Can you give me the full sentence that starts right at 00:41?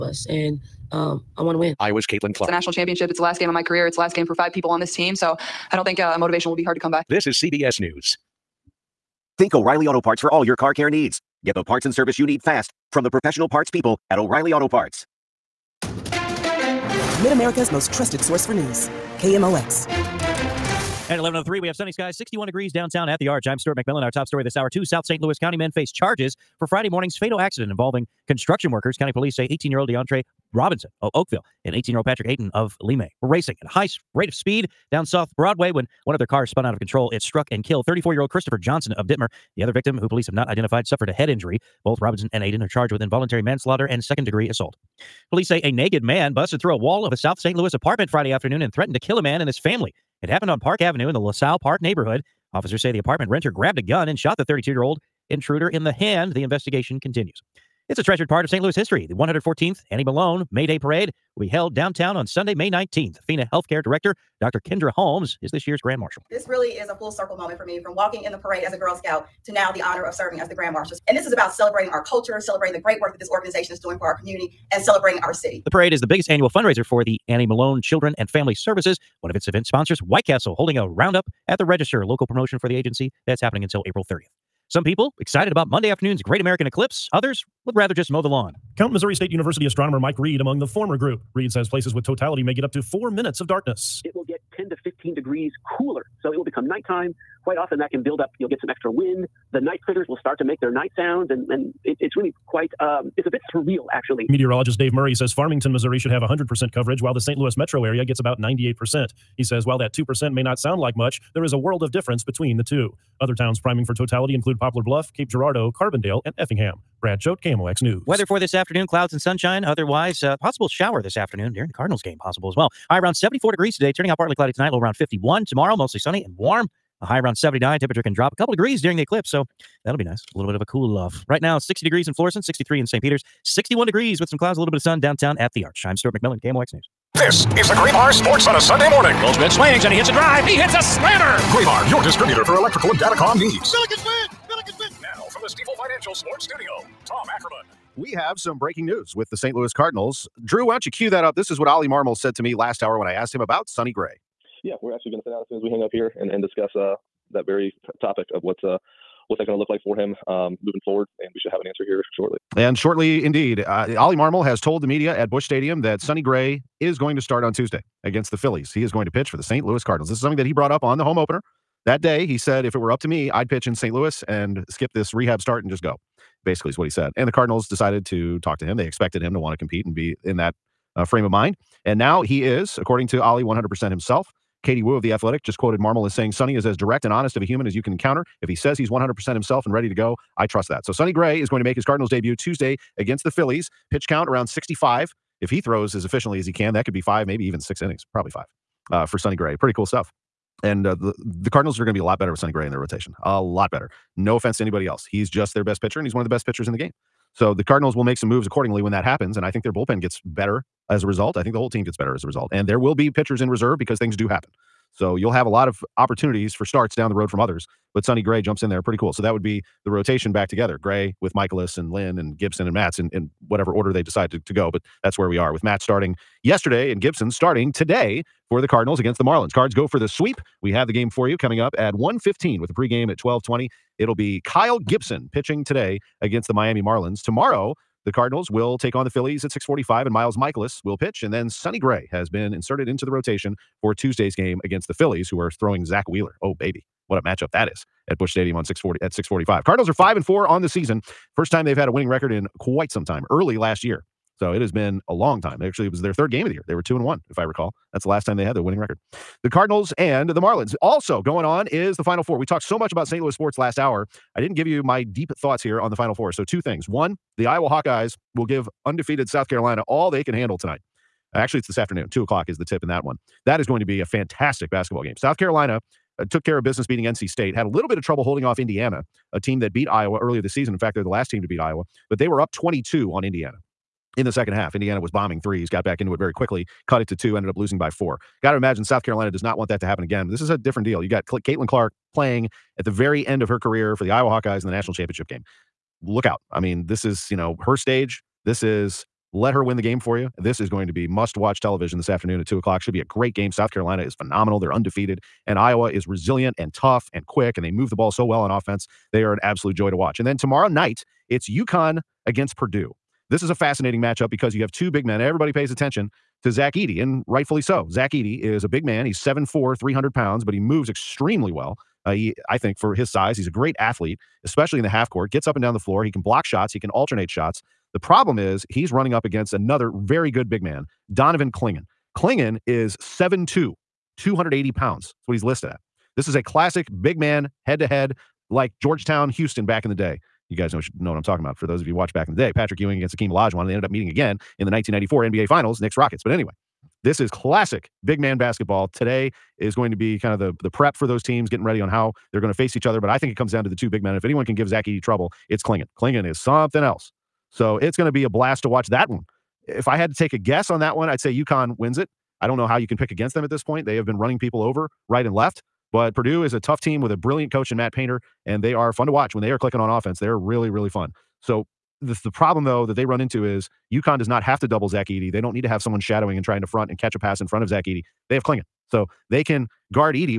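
Both Robinson and Aiden are charged with involuntary manslaughter and second degree assault.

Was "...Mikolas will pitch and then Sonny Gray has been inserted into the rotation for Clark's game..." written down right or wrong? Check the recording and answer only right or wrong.
wrong.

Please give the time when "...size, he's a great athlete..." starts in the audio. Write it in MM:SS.
05:23.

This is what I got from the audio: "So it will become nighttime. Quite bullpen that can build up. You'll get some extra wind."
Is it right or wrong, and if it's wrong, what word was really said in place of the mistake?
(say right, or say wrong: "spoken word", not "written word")
wrong: "often", not "bullpen".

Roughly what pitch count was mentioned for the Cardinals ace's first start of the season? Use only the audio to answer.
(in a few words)
65.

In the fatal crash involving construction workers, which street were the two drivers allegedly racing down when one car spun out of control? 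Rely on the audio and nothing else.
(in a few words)
South Broadway.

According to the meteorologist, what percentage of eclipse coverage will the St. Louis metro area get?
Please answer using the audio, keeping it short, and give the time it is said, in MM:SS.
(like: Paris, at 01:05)
98%, at 01:48.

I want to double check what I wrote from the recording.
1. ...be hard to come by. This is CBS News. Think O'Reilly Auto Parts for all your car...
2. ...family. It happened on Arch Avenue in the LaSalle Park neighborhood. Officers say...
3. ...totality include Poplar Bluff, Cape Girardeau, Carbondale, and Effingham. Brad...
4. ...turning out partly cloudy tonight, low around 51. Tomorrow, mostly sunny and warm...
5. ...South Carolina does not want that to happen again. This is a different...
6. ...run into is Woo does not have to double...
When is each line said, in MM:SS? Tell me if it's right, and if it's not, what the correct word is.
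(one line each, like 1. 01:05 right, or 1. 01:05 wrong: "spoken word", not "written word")
1. 00:06 right
2. 00:49 wrong: "Park", not "Arch"
3. 01:53 right
4. 02:03 right
5. 04:48 right
6. 06:13 wrong: "UConn", not "Woo".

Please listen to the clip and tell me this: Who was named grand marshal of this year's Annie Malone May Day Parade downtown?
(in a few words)
Dr. Kendra Holmes.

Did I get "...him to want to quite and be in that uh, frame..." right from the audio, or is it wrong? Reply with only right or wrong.
wrong.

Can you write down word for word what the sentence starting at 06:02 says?
I don't know how you can pick against them at this point.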